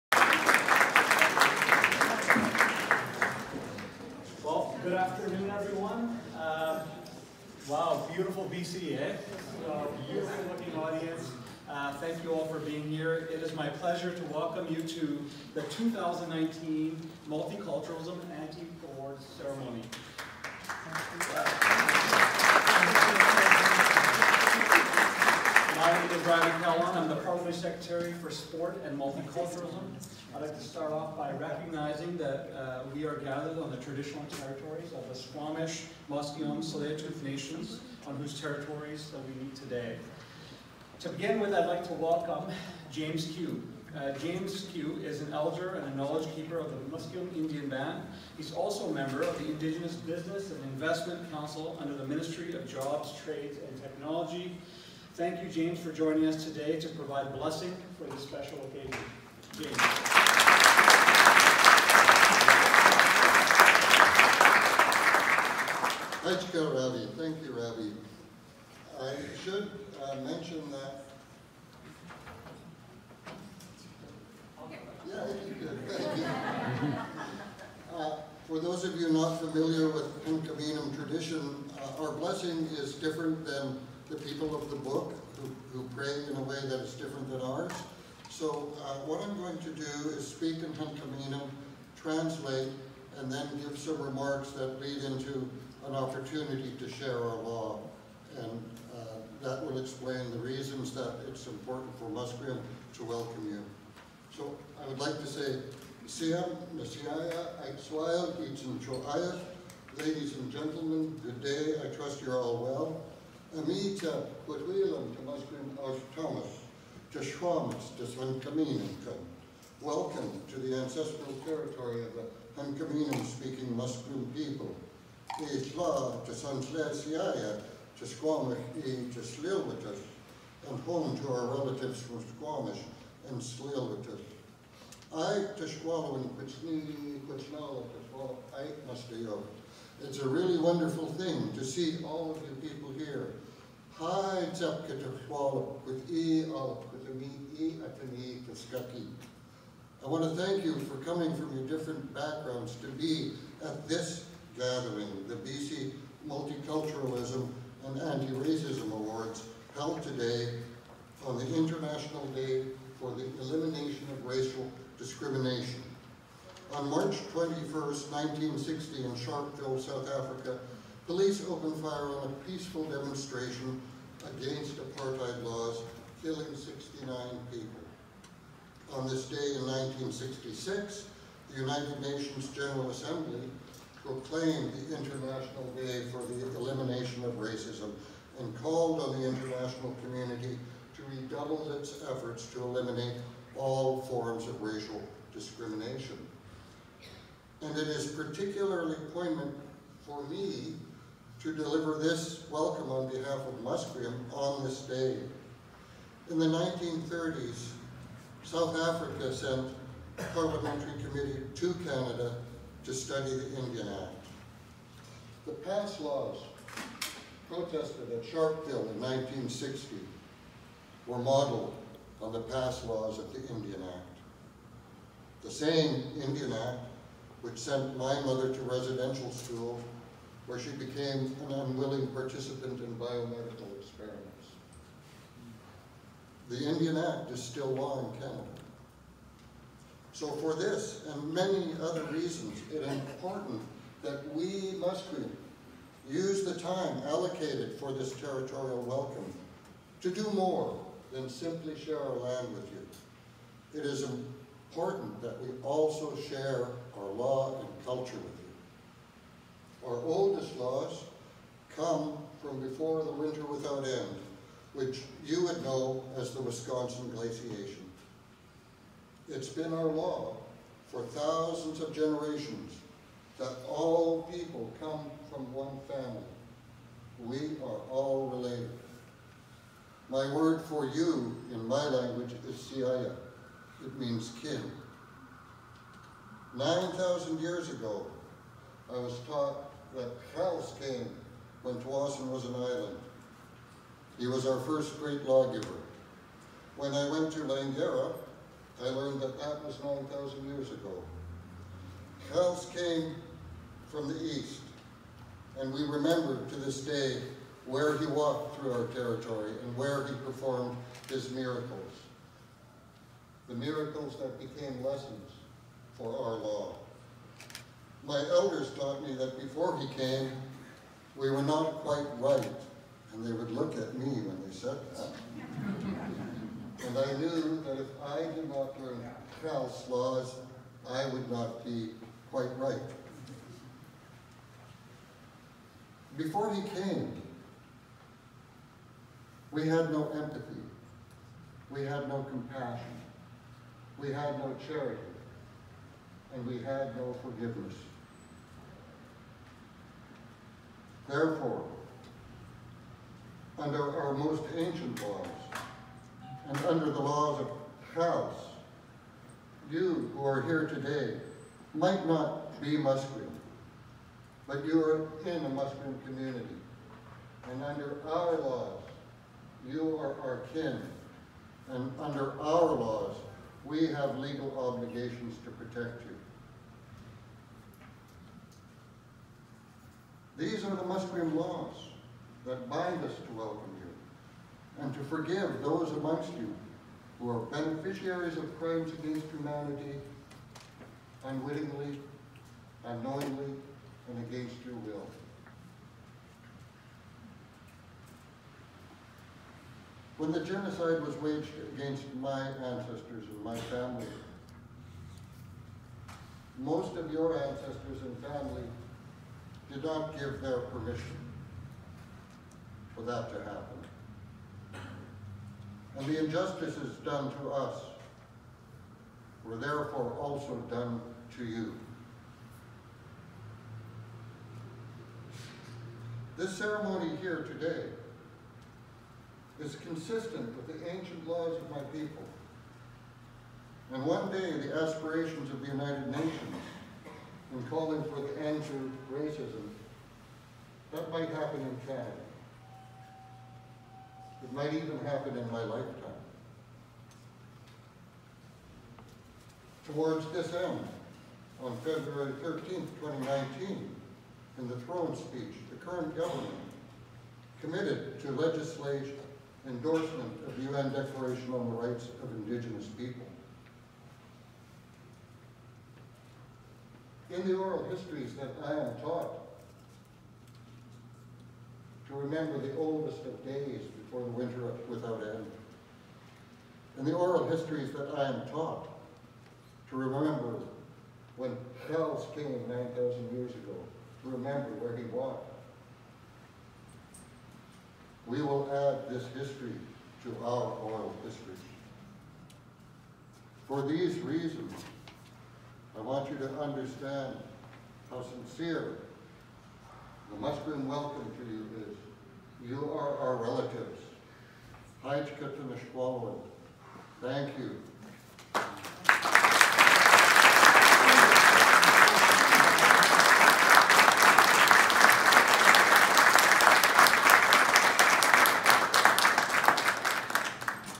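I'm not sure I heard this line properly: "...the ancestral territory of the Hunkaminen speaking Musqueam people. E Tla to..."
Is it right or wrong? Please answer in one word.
right.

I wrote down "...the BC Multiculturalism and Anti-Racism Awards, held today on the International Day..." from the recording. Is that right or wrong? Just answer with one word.
right.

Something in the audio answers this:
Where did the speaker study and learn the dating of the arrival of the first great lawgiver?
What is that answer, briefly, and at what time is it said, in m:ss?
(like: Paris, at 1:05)
Langara, at 4:57.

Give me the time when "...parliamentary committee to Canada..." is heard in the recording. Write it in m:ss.
3:30.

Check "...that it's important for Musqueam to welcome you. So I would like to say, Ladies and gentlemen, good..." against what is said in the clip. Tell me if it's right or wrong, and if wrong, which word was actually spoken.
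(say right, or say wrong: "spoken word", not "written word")
right.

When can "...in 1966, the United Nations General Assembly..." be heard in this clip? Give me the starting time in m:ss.
2:59.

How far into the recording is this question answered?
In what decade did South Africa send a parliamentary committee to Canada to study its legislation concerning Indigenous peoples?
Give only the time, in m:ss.
3:26.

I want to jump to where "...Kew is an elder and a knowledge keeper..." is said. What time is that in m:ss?
0:44.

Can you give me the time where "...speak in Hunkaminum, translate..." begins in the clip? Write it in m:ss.
1:30.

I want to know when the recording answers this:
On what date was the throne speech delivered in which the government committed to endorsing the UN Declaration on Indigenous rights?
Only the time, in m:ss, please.
7:31.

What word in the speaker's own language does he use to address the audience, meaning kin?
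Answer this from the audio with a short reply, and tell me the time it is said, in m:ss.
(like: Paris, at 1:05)
siaya, at 4:42.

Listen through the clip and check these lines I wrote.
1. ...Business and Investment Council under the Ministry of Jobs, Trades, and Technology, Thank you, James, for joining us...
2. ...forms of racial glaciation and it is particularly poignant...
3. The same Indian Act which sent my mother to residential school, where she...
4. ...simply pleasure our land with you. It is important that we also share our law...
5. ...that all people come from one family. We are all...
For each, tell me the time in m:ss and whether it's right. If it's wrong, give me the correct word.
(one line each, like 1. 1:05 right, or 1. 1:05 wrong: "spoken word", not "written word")
1. 0:49 right
2. 3:14 wrong: "discrimination", not "glaciation"
3. 3:45 right
4. 4:11 wrong: "share", not "pleasure"
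5. 4:33 right.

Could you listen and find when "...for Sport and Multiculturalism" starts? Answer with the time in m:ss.
0:28.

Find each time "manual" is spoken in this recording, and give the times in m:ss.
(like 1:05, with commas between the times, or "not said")
not said.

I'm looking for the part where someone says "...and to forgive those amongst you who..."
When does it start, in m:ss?
6:24.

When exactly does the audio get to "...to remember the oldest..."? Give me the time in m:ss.
7:52.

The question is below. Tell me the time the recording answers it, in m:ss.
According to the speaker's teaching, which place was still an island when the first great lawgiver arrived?
4:51.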